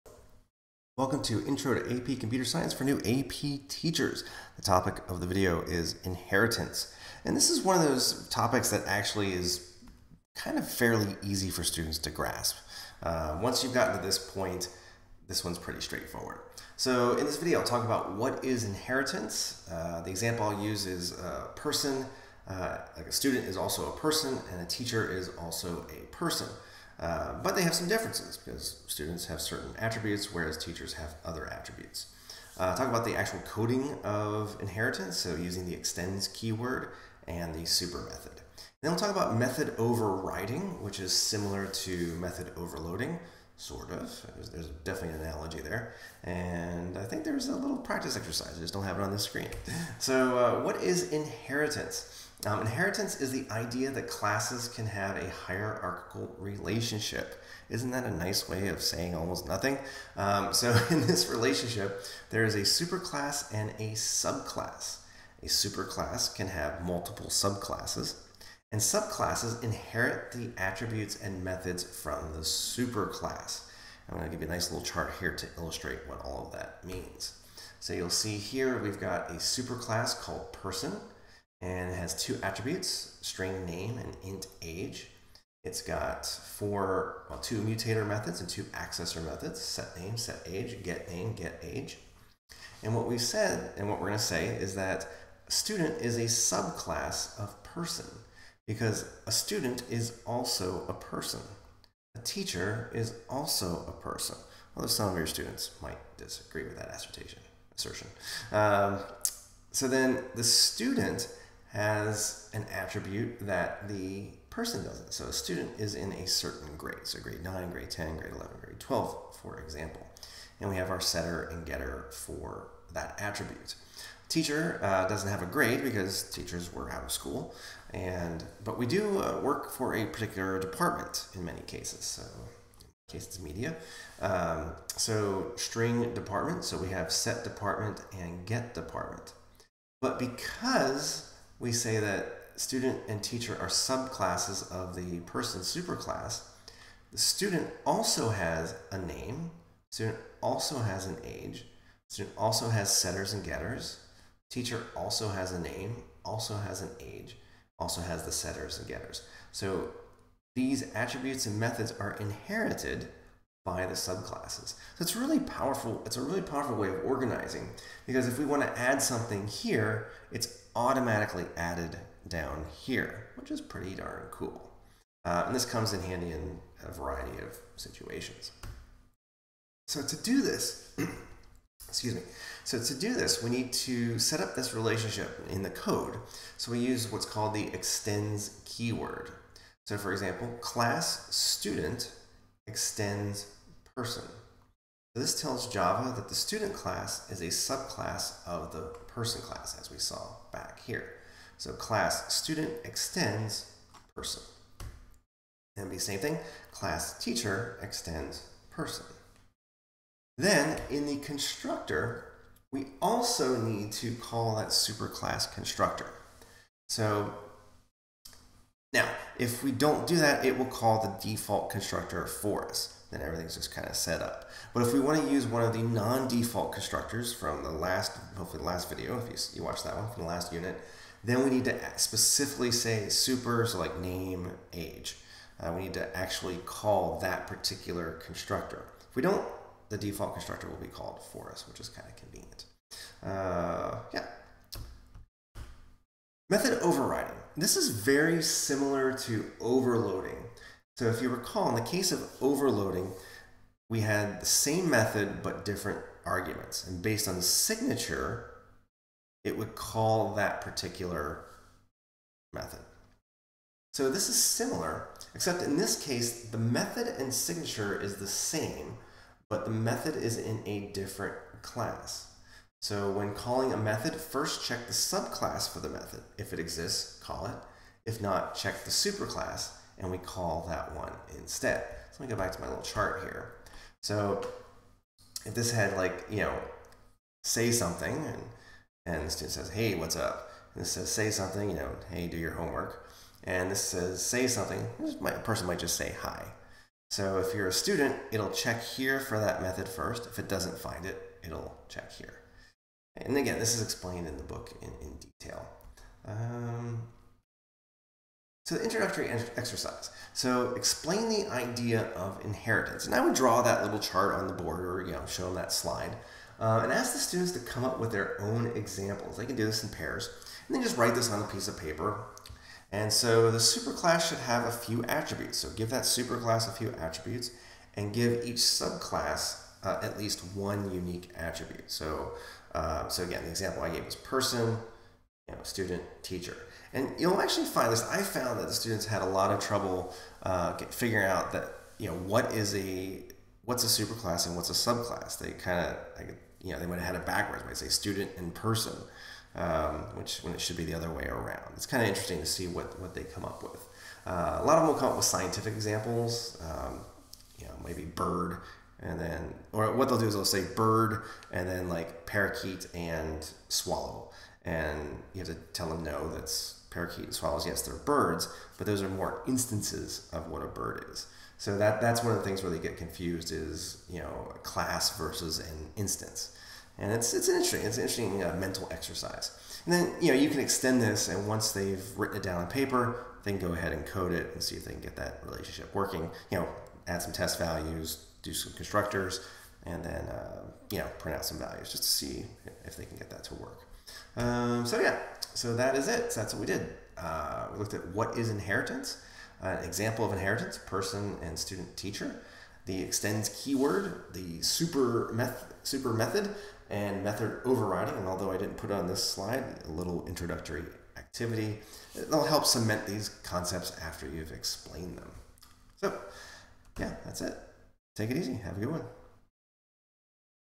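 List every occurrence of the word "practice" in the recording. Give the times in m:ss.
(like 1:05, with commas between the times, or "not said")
0:47.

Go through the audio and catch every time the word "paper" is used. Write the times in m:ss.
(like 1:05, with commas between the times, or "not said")
5:21, 6:22.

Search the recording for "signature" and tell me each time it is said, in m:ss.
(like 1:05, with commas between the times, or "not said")
4:17, 4:27.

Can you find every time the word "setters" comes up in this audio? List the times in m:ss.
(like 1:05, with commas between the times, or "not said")
2:00, 2:32, 2:38.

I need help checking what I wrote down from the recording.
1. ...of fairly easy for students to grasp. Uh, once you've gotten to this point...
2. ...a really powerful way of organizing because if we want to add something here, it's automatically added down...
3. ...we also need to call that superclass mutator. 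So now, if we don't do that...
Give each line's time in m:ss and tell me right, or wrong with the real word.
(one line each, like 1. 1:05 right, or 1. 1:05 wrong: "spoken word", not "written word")
1. 0:10 right
2. 2:46 right
3. 3:32 wrong: "constructor", not "mutator".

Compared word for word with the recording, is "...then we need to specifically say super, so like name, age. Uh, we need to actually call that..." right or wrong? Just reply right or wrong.
right.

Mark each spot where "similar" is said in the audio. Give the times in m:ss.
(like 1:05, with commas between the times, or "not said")
0:41, 4:08, 4:24.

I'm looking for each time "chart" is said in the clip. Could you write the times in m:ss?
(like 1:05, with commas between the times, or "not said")
1:14, 4:42, 5:13.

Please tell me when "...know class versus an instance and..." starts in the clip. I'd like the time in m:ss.
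6:14.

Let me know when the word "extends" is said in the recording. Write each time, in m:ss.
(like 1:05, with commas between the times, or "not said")
0:35, 3:07, 3:12, 3:22, 3:27, 6:20, 6:43.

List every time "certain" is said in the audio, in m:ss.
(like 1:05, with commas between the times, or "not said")
0:29, 1:56.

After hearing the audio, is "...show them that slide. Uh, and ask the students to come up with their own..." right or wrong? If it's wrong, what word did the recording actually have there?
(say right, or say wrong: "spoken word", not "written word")
right.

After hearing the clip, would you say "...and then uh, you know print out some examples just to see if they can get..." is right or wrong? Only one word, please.
wrong.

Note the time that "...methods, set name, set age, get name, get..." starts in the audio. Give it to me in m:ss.
1:29.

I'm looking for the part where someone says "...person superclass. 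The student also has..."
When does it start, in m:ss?
2:25.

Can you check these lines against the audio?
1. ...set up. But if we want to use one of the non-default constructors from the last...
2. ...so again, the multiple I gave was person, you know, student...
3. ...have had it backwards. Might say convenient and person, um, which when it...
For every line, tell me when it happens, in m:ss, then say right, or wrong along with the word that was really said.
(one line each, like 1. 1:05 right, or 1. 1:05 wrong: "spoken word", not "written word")
1. 3:43 right
2. 5:33 wrong: "example", not "multiple"
3. 5:46 wrong: "student", not "convenient".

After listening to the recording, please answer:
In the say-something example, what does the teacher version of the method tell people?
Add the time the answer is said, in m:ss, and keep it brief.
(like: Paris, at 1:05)
Do your homework, at 4:52.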